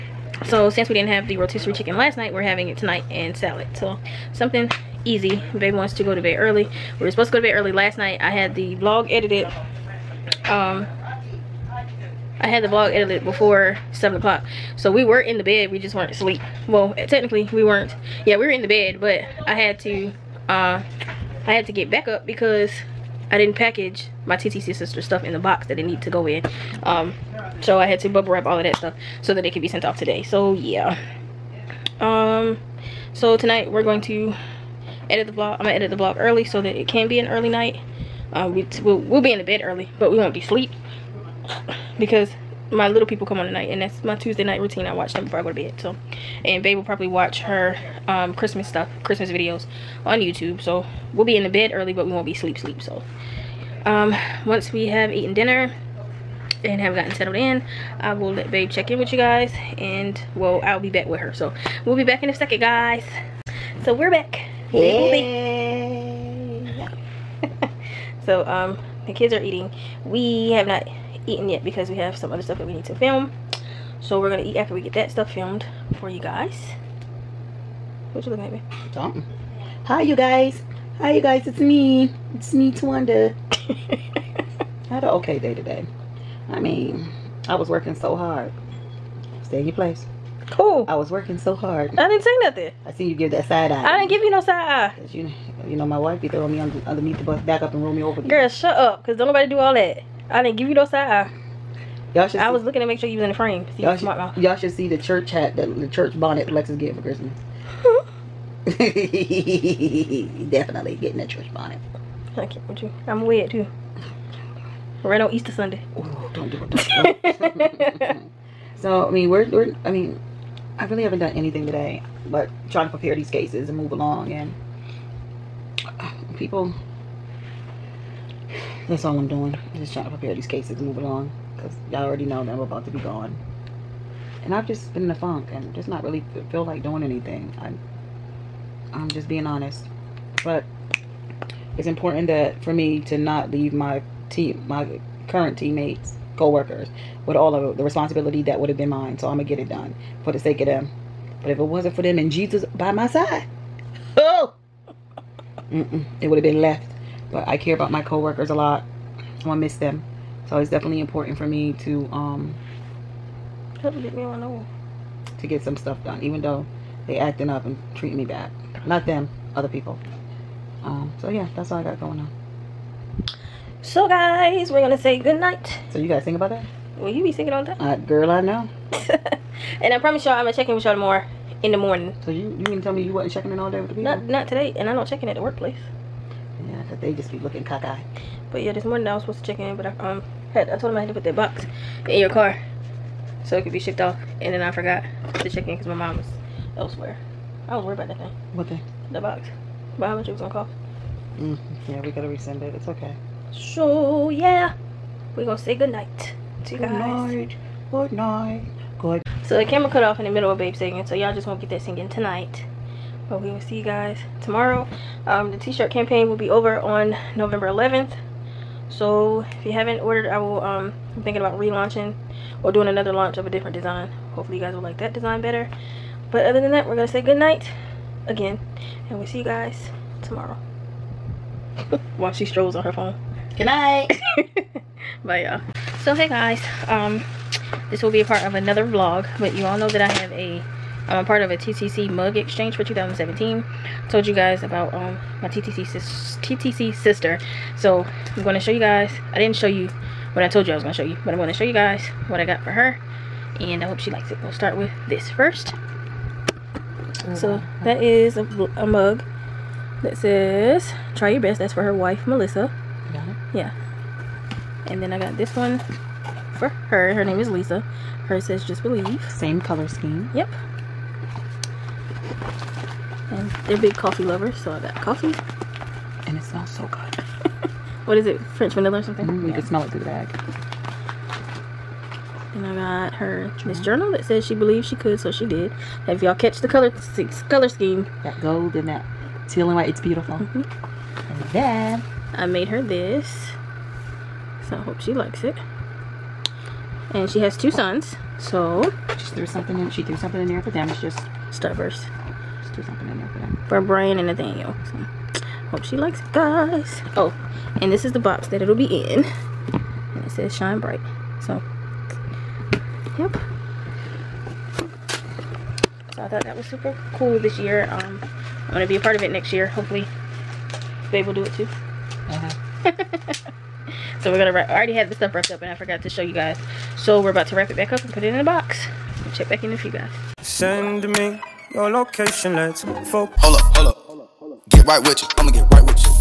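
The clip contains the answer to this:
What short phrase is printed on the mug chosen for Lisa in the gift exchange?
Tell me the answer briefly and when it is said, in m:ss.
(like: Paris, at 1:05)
Just believe, at 4:28.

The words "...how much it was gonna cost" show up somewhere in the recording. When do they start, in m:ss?
3:20.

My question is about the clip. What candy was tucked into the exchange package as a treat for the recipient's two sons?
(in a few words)
Starburst.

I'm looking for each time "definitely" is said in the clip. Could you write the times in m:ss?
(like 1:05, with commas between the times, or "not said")
1:50, 2:40.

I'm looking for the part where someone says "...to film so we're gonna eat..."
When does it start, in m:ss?
1:12.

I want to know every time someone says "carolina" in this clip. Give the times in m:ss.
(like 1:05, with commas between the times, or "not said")
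not said.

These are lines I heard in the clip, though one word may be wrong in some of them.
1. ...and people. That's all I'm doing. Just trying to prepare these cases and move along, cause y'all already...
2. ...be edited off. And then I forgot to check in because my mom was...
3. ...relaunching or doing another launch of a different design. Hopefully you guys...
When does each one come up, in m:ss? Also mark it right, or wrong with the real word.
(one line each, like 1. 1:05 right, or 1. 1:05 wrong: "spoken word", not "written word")
1. 2:04 right
2. 3:13 wrong: "shipped", not "edited"
3. 3:41 right.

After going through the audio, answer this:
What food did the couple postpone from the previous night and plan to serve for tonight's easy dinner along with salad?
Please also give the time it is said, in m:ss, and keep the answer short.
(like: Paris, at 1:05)
Rotisserie chicken, at 0:01.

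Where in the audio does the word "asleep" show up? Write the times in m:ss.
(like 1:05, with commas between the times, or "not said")
0:16, 0:40.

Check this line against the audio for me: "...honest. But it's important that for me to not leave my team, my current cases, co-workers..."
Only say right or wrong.
wrong.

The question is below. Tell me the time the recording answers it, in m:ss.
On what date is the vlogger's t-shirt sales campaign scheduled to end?
3:37.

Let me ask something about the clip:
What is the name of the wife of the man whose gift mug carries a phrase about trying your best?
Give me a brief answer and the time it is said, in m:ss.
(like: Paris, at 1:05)
Melissa, at 4:22.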